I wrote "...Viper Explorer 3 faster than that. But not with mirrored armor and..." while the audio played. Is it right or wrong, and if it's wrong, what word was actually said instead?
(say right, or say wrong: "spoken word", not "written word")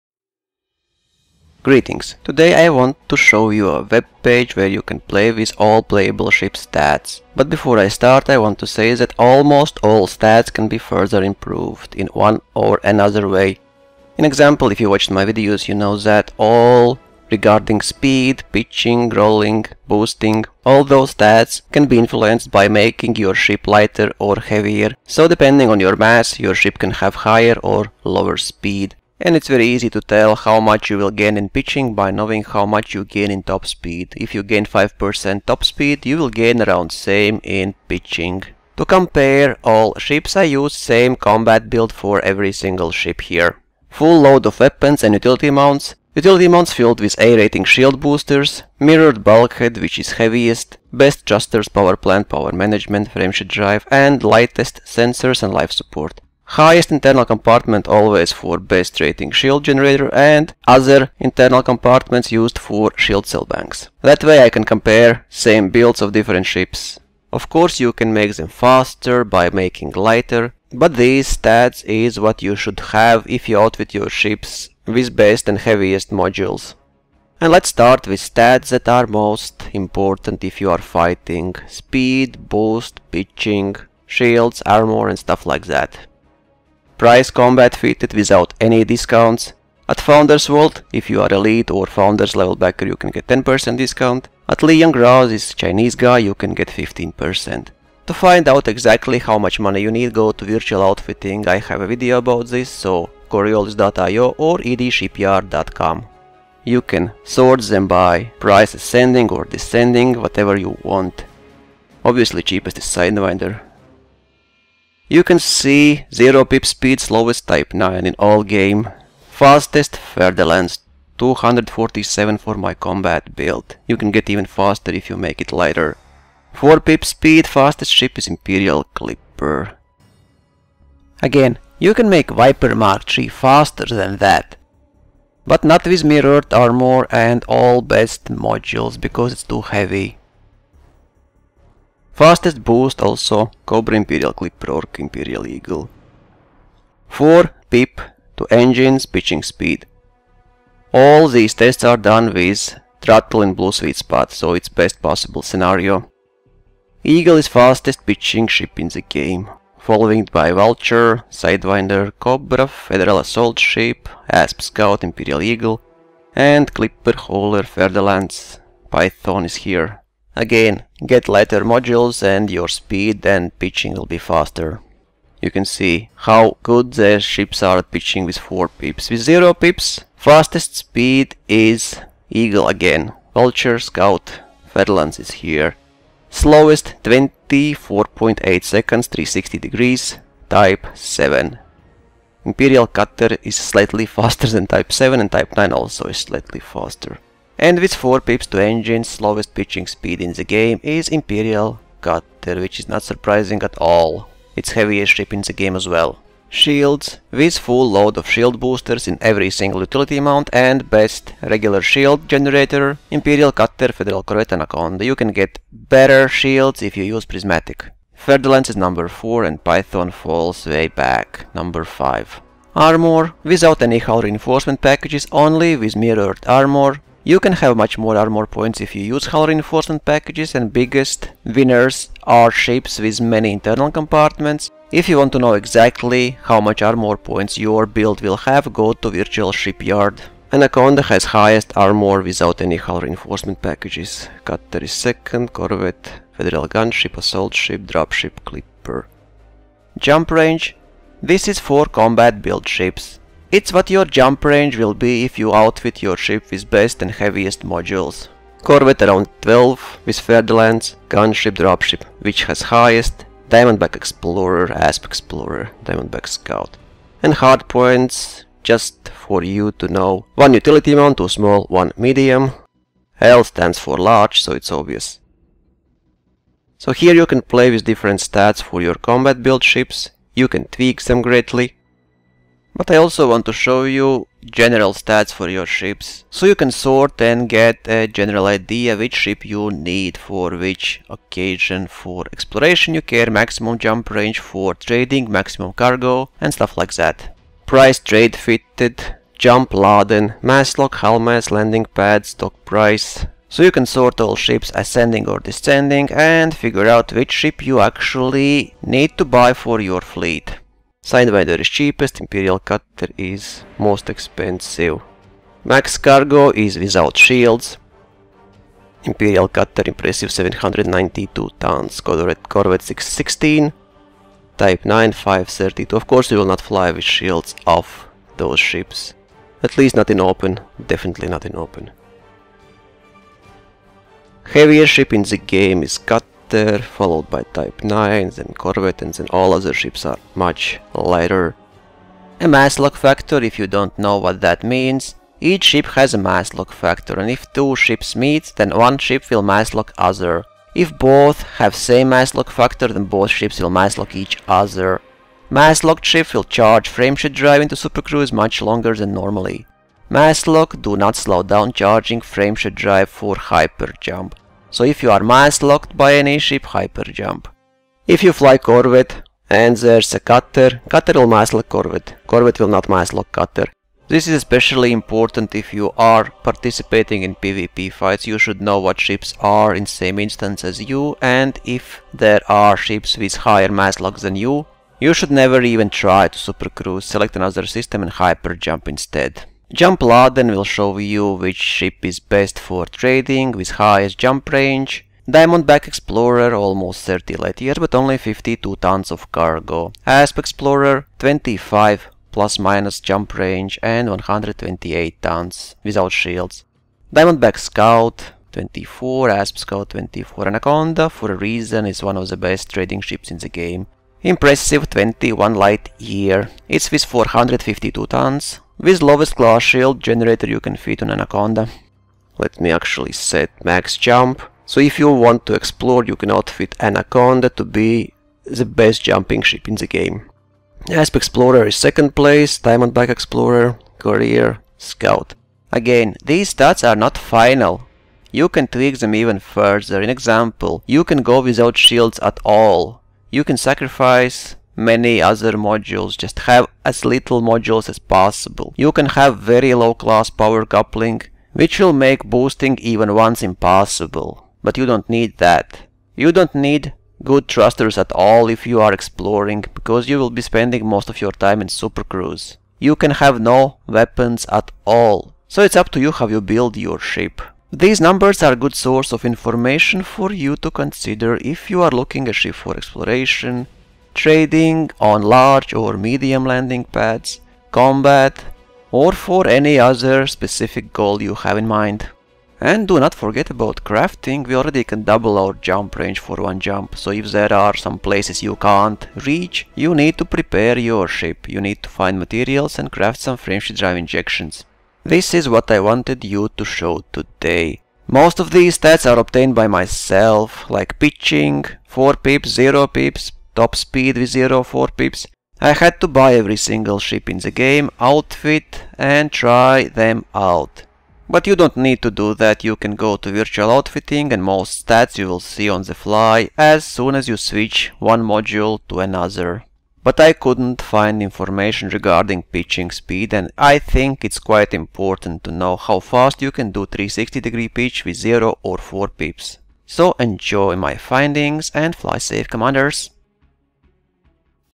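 wrong: "Mark", not "Explorer".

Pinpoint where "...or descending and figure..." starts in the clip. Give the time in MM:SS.
05:05.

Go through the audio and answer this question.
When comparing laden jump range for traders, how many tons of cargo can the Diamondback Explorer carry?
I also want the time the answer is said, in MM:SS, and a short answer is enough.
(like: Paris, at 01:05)
52 tons, at 06:38.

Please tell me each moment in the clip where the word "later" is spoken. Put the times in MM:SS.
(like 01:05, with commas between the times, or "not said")
05:36, 05:40.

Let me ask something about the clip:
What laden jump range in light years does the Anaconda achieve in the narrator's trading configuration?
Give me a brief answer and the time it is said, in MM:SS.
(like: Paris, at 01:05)
21 light years, at 06:54.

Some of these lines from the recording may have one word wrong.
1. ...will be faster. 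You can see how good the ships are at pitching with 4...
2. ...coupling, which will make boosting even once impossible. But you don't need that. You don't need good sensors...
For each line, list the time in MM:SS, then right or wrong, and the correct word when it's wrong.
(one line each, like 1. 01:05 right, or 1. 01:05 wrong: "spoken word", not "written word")
1. 02:53 right
2. 07:30 wrong: "thrusters", not "sensors".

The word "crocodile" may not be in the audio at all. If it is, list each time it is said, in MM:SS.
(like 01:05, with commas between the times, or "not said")
not said.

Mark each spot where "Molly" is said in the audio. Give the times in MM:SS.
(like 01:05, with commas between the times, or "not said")
not said.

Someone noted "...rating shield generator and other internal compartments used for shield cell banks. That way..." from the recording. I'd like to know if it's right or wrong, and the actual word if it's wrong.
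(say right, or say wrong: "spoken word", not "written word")
right.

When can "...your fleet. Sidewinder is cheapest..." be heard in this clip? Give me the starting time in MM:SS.
05:09.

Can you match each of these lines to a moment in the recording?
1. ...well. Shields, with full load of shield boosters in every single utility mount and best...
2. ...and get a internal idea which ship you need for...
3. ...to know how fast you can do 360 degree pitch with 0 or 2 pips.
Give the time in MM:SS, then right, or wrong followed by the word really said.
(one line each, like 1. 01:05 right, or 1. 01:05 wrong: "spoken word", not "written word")
1. 03:25 right
2. 04:47 wrong: "general", not "internal"
3. 08:45 wrong: "4", not "2".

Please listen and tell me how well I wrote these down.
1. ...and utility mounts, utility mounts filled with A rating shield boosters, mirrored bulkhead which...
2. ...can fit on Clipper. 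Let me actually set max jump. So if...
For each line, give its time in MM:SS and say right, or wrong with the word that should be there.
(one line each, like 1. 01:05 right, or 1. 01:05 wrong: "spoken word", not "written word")
1. 00:45 right
2. 07:00 wrong: "Anaconda", not "Clipper".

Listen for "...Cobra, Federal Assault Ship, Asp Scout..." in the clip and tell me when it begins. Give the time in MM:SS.
02:42.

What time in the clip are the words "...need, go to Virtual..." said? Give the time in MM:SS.
01:39.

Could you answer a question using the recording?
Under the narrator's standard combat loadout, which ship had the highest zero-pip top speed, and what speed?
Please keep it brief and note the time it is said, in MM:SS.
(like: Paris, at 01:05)
Fer-de-Lance, 247, at 01:59.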